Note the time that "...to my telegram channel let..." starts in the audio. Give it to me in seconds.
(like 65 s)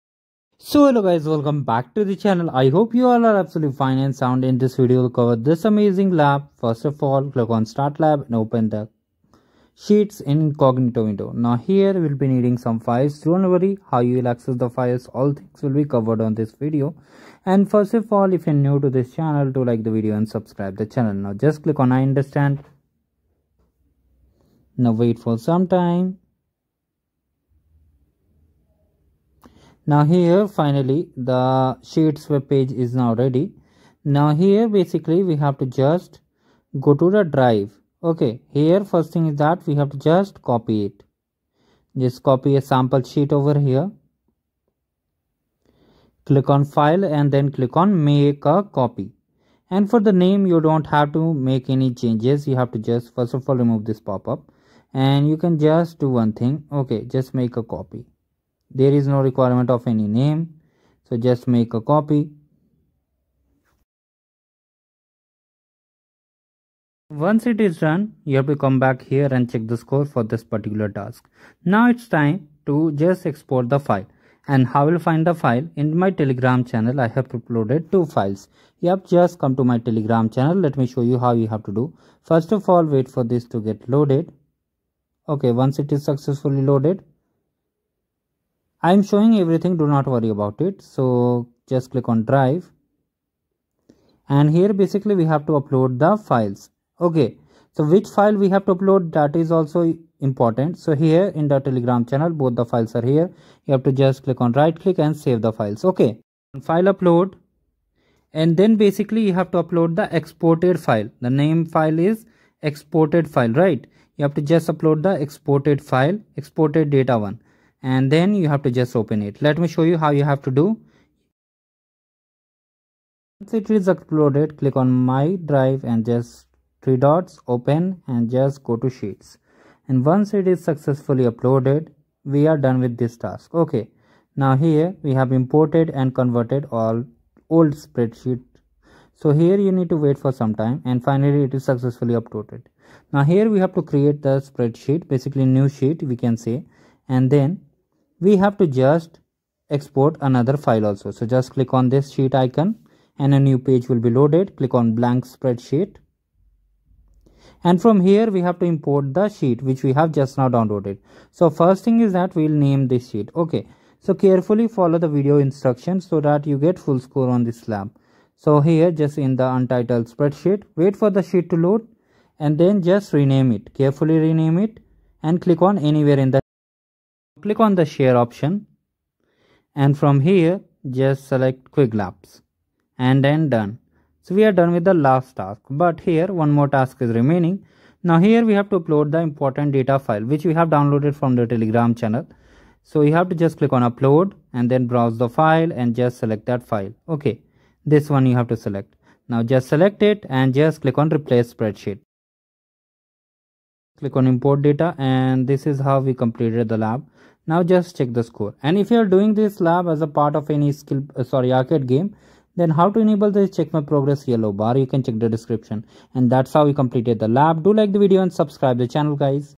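79 s.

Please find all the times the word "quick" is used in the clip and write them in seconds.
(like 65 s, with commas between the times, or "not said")
not said.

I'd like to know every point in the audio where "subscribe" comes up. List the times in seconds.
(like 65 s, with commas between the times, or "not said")
20 s, 218 s.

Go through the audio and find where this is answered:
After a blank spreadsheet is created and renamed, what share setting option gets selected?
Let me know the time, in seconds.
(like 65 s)
181 s.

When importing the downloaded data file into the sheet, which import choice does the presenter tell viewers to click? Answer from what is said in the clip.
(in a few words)
Replace spreadsheet.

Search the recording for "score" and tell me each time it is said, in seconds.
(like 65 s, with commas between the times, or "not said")
69 s, 167 s, 208 s.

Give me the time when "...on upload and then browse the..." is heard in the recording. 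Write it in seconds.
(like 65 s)
193 s.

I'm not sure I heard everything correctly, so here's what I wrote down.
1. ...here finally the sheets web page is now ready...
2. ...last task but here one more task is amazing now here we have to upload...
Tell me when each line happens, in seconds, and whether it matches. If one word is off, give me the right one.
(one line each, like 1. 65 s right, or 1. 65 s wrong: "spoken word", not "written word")
1. 30 s right
2. 184 s wrong: "remaining", not "amazing".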